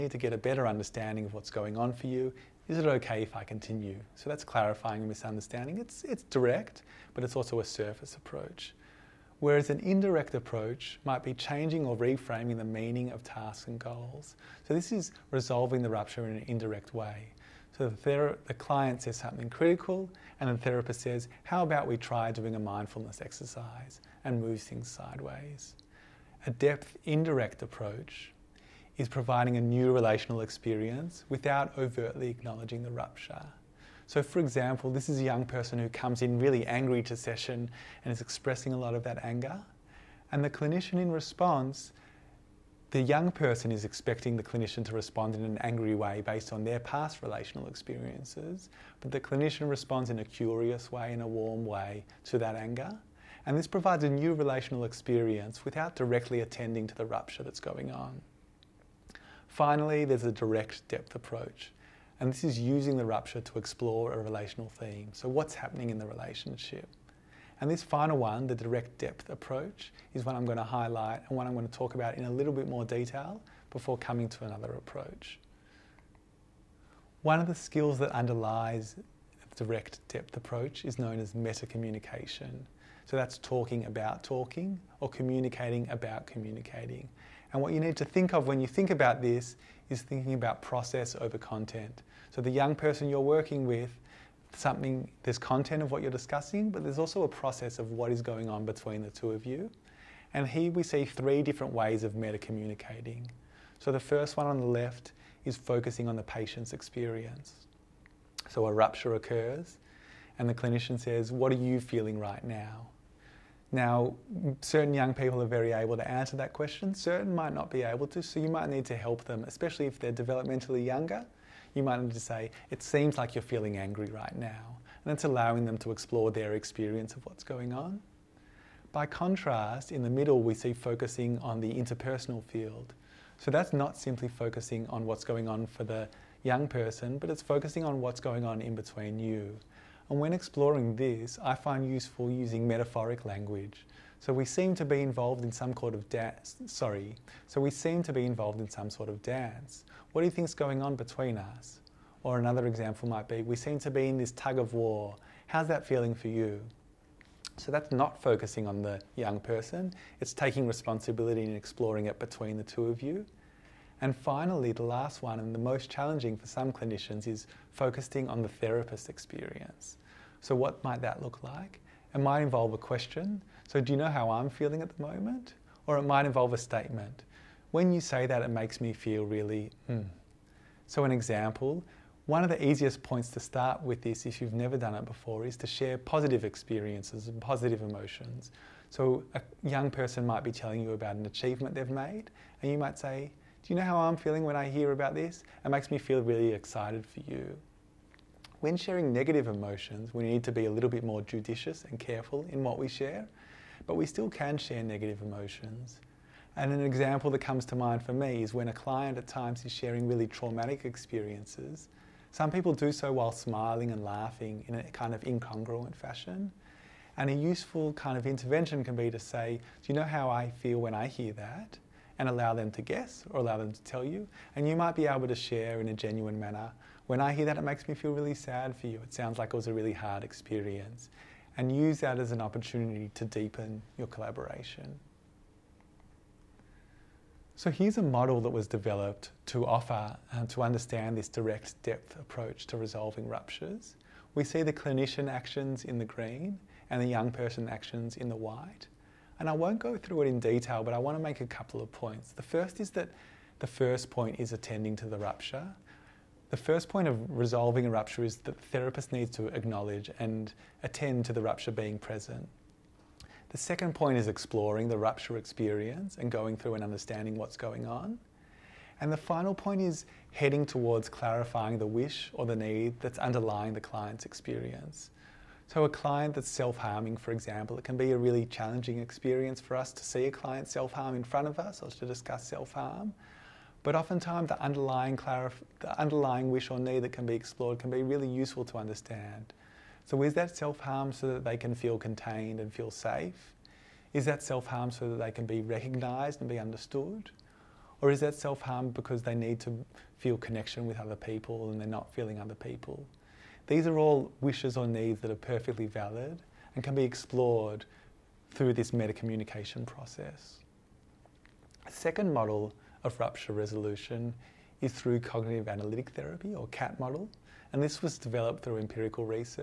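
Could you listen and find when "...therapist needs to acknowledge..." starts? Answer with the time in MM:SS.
04:18.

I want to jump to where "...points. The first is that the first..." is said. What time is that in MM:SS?
04:11.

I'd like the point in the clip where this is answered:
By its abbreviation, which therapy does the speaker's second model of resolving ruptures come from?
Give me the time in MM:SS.
05:16.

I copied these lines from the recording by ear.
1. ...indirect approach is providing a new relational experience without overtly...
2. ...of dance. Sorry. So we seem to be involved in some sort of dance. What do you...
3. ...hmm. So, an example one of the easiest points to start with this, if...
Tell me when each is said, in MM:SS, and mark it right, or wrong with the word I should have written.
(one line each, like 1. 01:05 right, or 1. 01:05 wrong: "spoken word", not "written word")
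1. 00:27 right
2. 02:25 right
3. 02:59 right.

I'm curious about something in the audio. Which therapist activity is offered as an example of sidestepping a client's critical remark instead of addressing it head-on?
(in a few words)
mindfulness exercise.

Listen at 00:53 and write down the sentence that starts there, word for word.
And this provides a new relational experience without directly attending to the rupture that's going on.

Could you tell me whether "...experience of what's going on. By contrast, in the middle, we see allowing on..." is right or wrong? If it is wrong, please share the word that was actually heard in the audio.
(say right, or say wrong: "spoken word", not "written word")
wrong: "focusing", not "allowing".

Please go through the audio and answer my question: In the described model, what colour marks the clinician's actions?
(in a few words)
green.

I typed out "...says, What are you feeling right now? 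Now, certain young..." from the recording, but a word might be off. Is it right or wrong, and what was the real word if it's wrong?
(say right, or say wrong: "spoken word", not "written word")
right.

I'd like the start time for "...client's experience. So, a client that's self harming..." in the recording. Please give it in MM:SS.
04:33.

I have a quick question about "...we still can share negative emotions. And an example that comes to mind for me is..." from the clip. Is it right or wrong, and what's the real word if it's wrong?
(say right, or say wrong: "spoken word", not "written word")
right.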